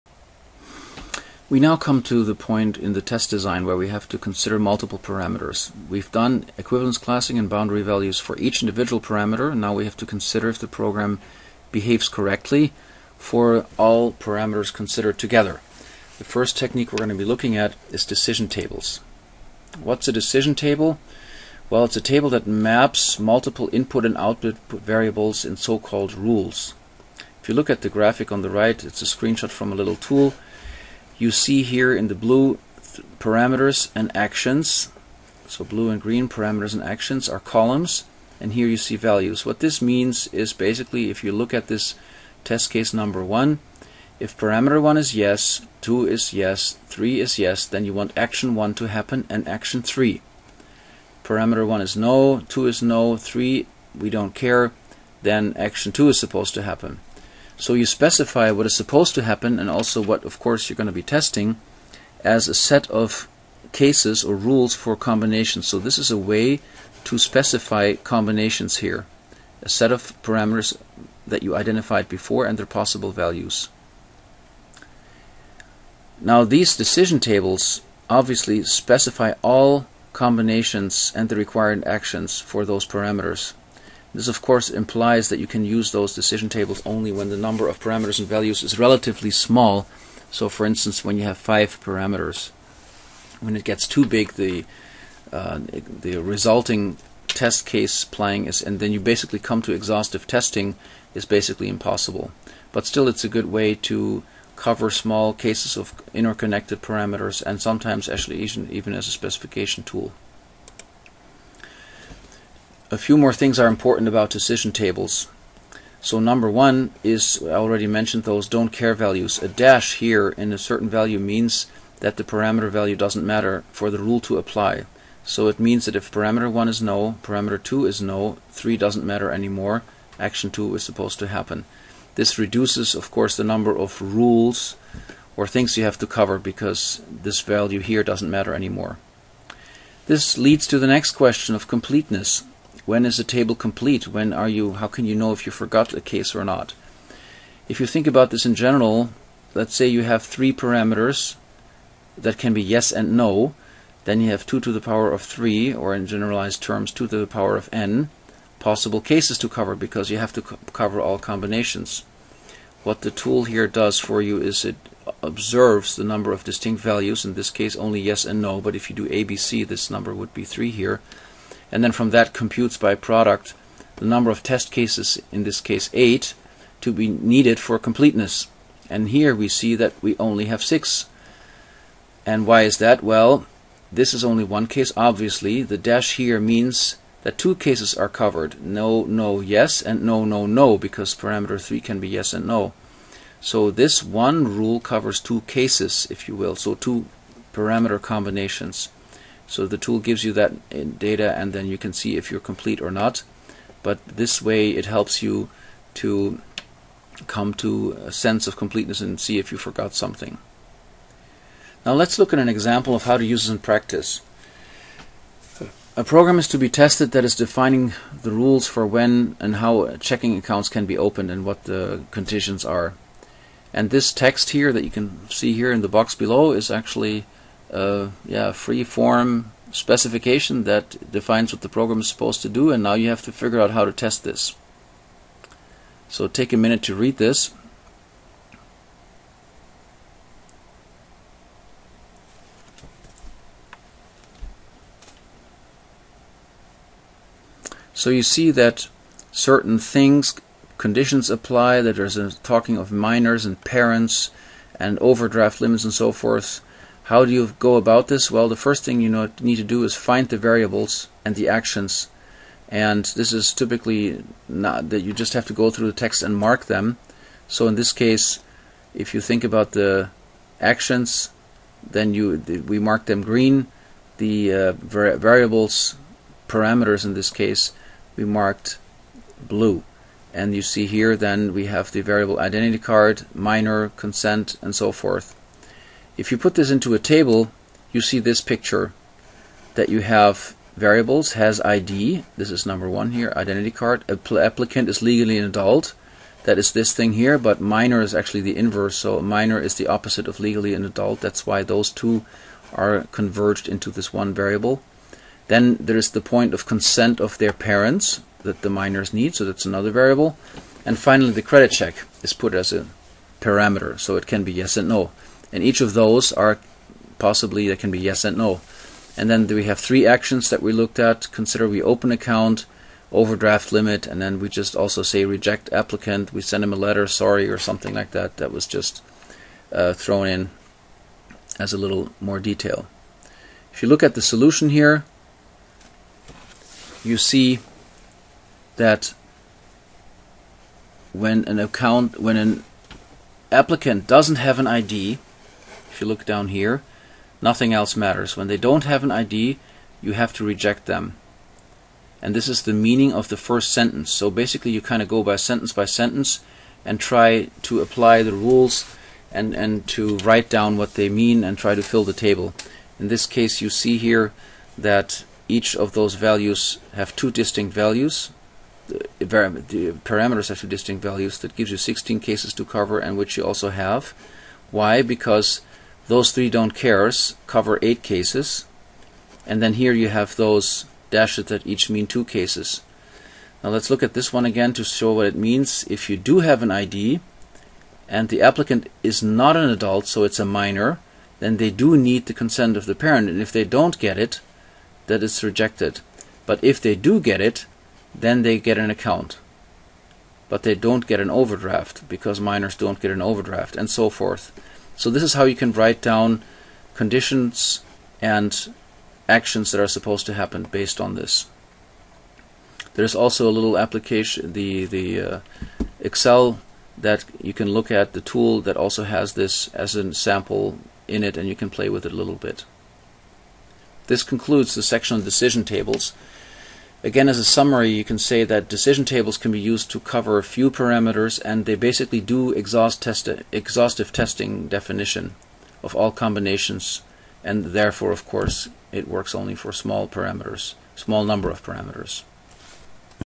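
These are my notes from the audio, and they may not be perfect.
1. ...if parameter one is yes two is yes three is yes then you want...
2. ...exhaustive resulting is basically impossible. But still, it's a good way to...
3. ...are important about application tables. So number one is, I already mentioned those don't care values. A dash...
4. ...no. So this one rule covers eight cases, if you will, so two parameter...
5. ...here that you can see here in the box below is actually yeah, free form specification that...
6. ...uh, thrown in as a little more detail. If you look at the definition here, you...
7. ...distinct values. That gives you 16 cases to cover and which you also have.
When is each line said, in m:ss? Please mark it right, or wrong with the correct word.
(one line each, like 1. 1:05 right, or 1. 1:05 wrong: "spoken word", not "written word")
1. 0:44 right
2. 1:39 wrong: "testing", not "resulting"
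3. 1:53 wrong: "decision", not "application"
4. 3:12 wrong: "two", not "eight"
5. 3:44 right
6. 5:29 wrong: "solution", not "definition"
7. 6:10 right.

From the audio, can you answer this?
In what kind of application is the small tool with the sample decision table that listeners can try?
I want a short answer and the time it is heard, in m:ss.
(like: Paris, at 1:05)
Excel, at 6:56.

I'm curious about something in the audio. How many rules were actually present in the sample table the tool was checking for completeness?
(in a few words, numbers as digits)
6.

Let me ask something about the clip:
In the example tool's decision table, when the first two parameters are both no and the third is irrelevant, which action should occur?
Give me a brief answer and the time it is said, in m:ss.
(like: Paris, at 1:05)
action 2, at 0:55.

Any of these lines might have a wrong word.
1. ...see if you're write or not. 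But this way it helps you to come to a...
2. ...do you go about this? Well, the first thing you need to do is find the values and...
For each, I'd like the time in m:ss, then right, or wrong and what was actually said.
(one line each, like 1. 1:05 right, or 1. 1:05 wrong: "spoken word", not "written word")
1. 3:21 wrong: "complete", not "write"
2. 4:17 wrong: "variables", not "values".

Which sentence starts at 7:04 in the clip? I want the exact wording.
This concludes the section on decision tables.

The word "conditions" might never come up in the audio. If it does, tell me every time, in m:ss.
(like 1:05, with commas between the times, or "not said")
3:42, 4:10, 6:46.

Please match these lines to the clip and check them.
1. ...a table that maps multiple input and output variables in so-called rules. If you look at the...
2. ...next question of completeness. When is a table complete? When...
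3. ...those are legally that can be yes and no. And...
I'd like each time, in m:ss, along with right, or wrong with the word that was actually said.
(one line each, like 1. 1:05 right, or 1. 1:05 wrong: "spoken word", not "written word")
1. 0:21 right
2. 2:20 right
3. 5:15 wrong: "possibly", not "legally".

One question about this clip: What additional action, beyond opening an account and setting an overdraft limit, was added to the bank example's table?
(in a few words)
reject applicant.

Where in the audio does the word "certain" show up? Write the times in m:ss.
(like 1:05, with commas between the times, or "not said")
2:00, 4:09.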